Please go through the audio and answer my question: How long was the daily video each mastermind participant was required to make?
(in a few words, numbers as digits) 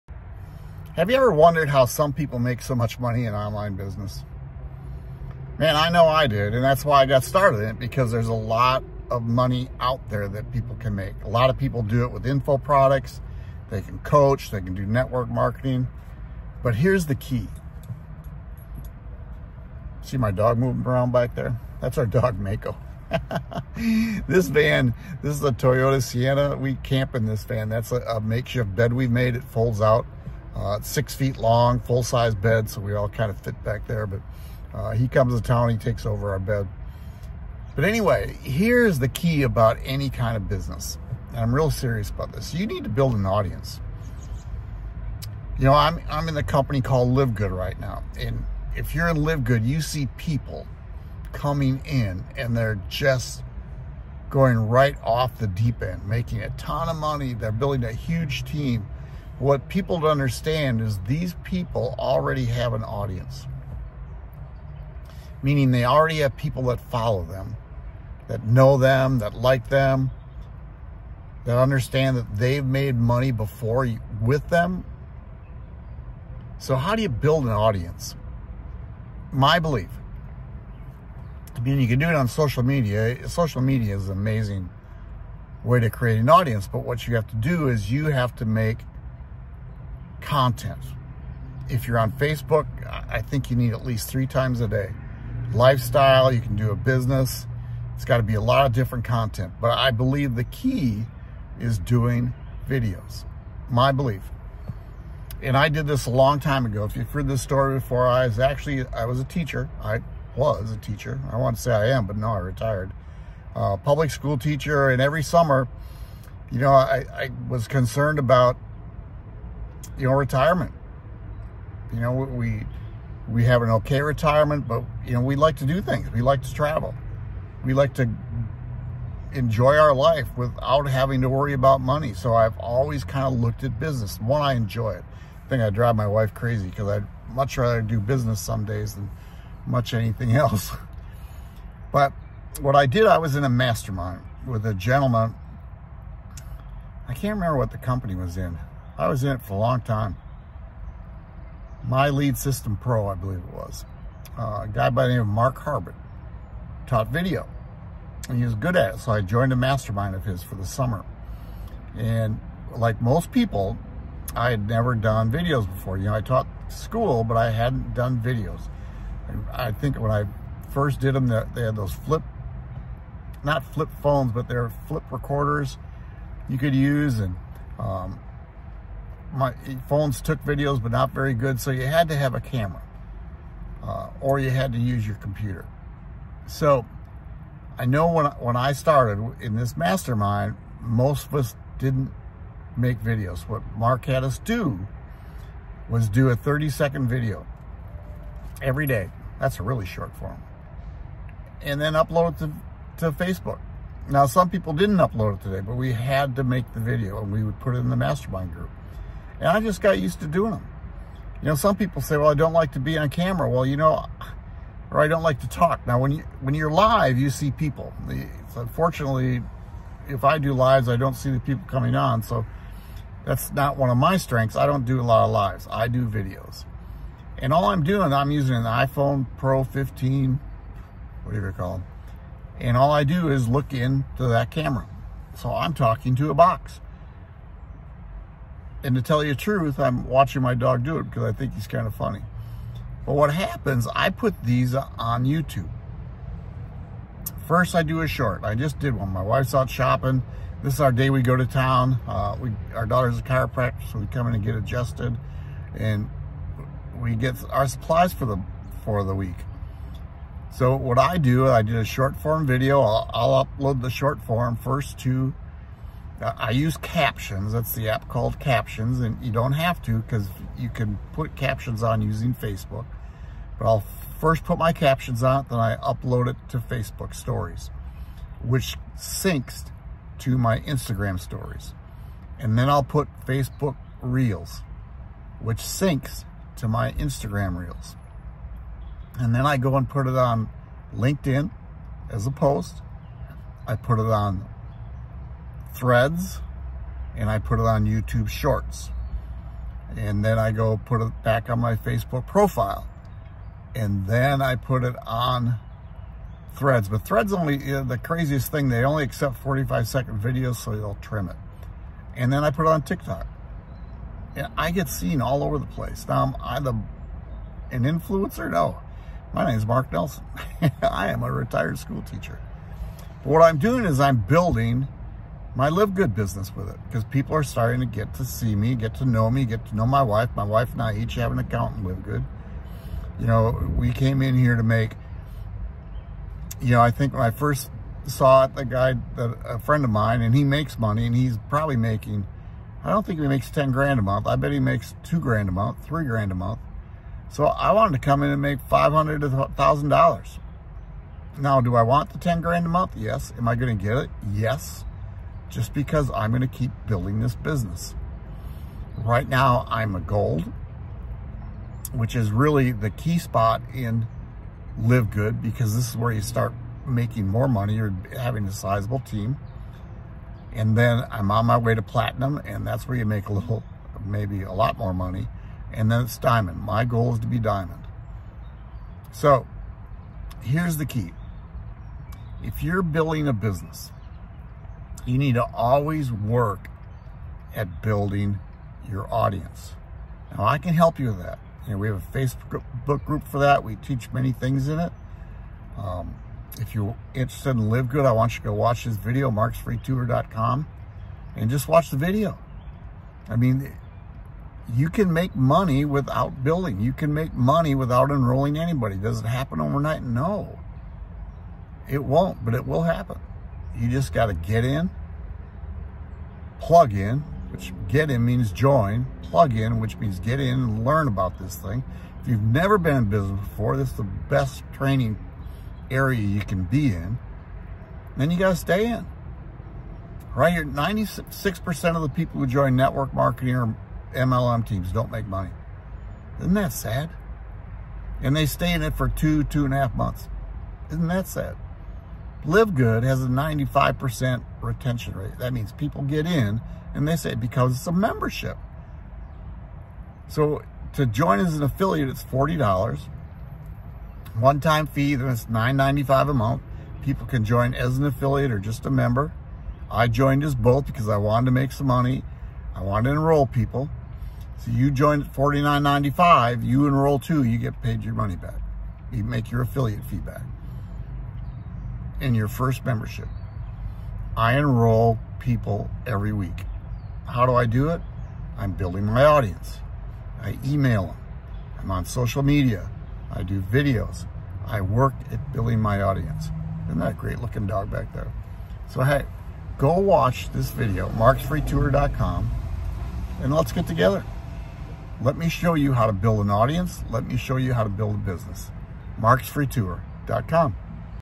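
30 seconds.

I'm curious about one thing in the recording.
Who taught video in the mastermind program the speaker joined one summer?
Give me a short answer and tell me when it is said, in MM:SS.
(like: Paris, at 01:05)
Mark Harbert, at 02:35.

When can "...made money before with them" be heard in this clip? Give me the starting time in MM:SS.
01:12.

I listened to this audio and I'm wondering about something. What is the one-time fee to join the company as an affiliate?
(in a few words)
$40.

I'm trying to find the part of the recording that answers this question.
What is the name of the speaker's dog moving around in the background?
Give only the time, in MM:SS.
00:22.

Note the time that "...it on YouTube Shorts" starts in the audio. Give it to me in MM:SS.
04:57.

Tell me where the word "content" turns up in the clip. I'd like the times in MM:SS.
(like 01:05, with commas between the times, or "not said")
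01:30, 01:39.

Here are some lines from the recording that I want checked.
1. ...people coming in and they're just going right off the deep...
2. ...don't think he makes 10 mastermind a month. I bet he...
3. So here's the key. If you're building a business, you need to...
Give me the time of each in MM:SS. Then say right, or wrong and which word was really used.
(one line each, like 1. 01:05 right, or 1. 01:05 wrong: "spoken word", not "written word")
1. 00:50 right
2. 05:42 wrong: "grand", not "mastermind"
3. 06:19 right.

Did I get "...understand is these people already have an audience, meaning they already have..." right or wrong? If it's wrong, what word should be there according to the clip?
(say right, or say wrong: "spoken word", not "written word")
right.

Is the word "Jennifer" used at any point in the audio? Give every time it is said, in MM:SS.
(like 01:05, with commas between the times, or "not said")
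not said.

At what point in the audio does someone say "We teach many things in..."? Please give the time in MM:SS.
06:33.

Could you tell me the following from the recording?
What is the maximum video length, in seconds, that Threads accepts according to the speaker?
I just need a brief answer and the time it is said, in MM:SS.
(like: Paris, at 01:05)
45, at 05:09.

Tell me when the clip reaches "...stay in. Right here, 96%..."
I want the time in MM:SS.
07:08.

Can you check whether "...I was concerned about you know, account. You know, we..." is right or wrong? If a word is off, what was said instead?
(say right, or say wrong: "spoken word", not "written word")
wrong: "retirement", not "account".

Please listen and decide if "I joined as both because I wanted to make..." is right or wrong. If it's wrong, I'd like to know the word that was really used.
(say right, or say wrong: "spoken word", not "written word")
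right.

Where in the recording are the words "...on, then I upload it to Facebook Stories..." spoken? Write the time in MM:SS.
04:35.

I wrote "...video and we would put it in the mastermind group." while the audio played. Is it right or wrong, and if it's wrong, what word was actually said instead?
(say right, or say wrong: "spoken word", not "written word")
right.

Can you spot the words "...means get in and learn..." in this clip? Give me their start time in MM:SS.
06:59.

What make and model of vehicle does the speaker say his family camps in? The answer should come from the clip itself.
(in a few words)
Toyota Sienna.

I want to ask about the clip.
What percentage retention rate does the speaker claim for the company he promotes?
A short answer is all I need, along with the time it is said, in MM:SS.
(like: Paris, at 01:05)
95%, at 07:23.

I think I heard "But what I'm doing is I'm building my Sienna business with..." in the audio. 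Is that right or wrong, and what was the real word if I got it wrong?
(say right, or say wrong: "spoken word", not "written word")
wrong: "LiveGood", not "Sienna".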